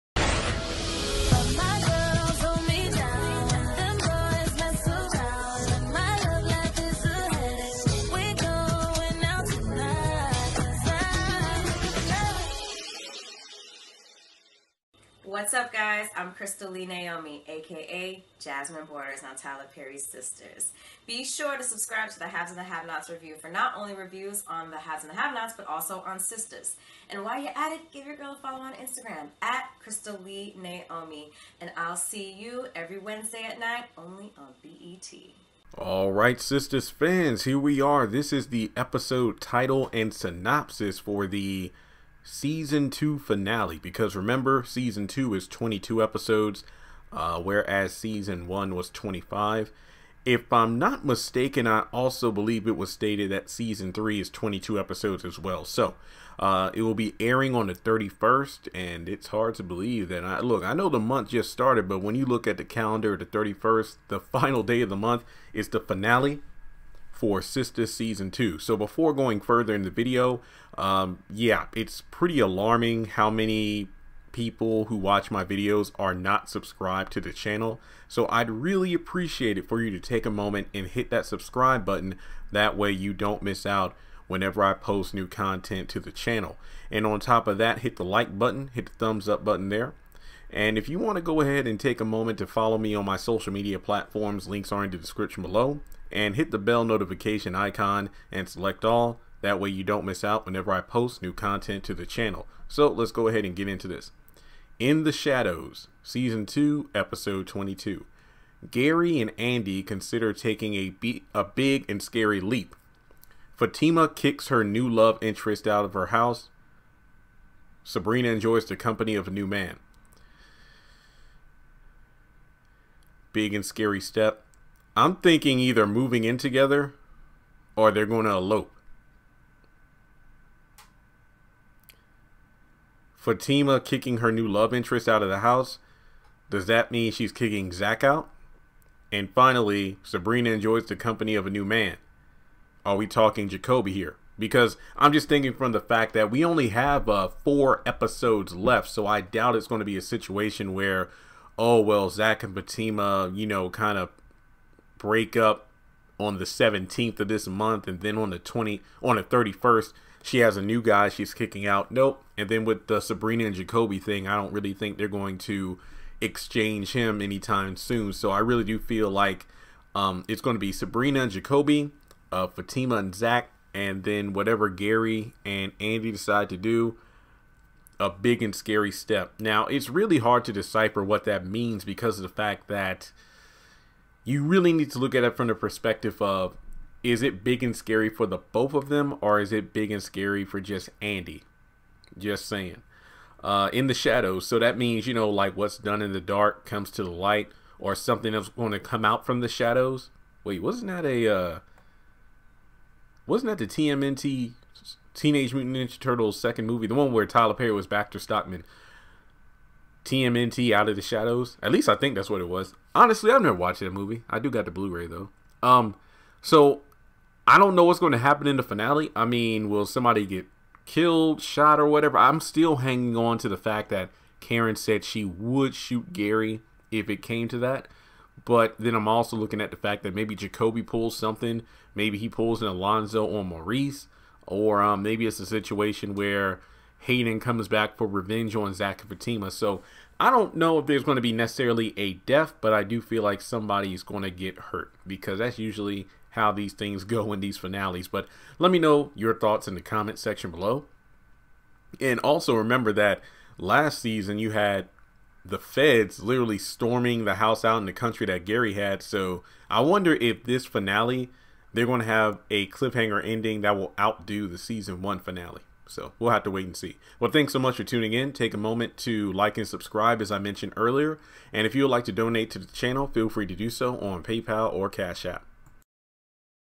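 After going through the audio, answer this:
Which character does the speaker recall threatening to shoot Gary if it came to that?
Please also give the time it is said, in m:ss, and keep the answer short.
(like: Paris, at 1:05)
Karen, at 3:44.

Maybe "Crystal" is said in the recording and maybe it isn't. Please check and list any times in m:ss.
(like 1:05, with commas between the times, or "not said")
0:16, 0:29.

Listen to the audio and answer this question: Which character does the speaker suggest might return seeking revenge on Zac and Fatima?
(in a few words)
Hayden.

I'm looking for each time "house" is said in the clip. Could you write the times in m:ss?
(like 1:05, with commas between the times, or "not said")
1:56, 2:15, 4:17.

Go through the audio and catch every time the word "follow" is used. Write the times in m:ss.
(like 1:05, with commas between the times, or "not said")
0:28, 1:32.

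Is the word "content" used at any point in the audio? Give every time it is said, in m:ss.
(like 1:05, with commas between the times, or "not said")
1:25, 1:41.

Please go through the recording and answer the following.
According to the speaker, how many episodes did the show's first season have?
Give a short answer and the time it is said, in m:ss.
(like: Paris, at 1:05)
25, at 0:48.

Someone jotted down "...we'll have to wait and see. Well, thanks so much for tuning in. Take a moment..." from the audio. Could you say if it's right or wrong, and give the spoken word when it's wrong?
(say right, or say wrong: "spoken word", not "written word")
right.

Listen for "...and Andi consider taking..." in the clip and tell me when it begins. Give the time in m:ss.
1:49.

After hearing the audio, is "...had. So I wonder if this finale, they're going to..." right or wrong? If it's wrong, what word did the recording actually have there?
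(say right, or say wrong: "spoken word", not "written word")
right.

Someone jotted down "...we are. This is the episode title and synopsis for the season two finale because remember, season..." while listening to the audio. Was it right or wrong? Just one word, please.
right.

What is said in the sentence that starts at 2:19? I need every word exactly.
And finally, Sabrina enjoys the company of a new man.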